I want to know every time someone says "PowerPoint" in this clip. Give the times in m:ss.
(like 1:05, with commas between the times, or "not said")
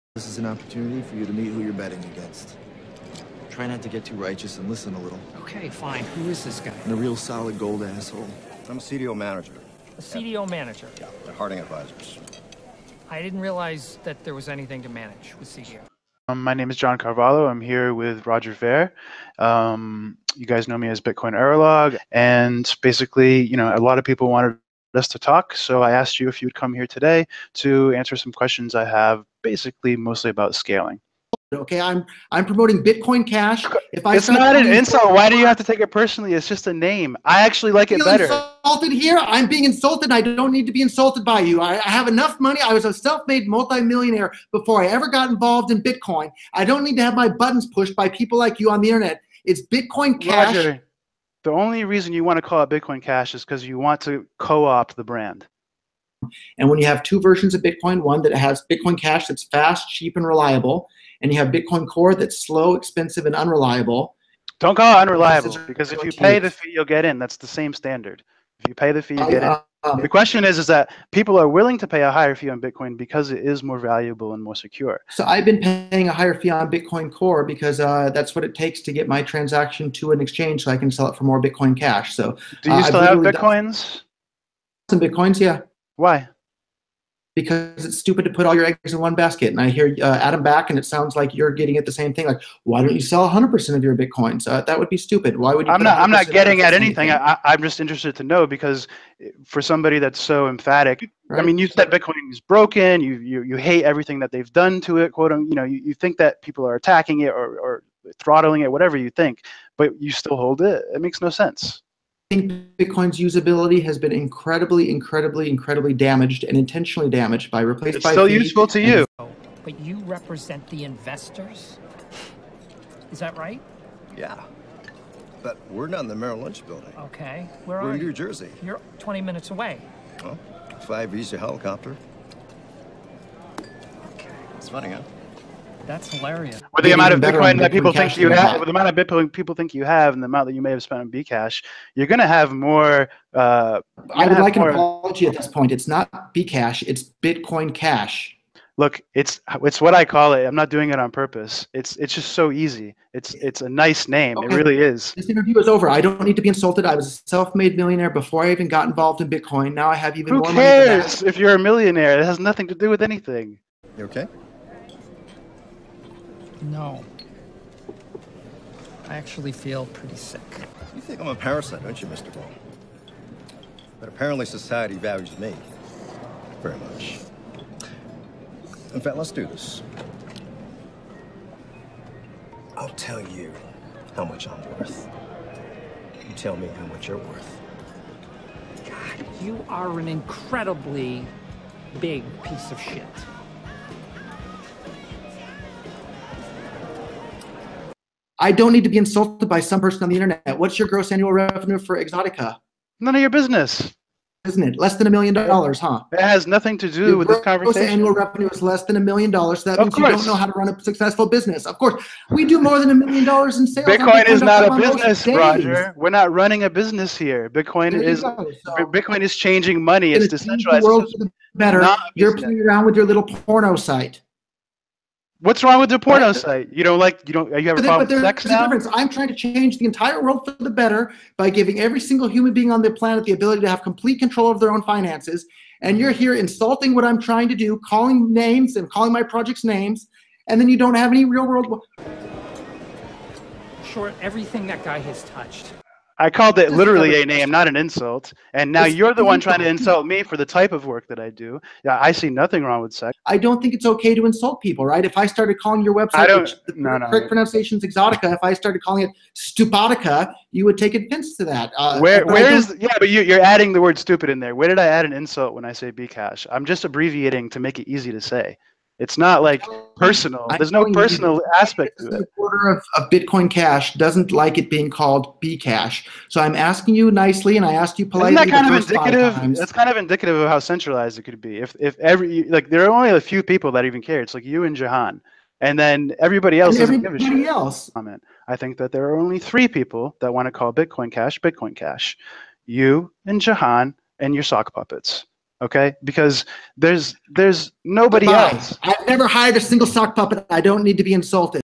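not said.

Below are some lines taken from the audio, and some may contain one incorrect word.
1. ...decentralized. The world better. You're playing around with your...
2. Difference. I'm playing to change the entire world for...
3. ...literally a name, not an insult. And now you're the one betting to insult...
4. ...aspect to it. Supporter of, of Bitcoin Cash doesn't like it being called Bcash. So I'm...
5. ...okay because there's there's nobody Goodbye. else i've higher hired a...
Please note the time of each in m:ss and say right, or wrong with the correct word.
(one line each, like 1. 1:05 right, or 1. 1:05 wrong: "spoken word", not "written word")
1. 3:40 right
2. 3:48 wrong: "trying", not "playing"
3. 4:06 wrong: "trying", not "betting"
4. 4:31 right
5. 4:55 wrong: "never", not "higher".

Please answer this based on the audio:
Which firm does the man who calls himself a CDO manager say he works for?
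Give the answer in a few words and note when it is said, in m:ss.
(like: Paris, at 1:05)
Harding Advisors, at 0:11.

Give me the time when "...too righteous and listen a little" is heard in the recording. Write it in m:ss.
0:04.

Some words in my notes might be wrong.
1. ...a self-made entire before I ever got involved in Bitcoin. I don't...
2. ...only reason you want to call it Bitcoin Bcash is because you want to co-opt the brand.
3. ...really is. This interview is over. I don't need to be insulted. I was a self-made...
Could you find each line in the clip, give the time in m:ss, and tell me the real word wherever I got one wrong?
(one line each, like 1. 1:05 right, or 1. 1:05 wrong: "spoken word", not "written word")
1. 0:42 wrong: "multimillionaire", not "entire"
2. 0:51 wrong: "Cash", not "Bcash"
3. 2:34 right.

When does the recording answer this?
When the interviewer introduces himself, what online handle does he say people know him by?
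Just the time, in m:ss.
0:20.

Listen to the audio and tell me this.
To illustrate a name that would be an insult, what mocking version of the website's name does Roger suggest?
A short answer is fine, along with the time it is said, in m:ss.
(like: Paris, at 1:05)
Stupotica, at 4:19.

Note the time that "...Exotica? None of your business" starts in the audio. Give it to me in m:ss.
3:22.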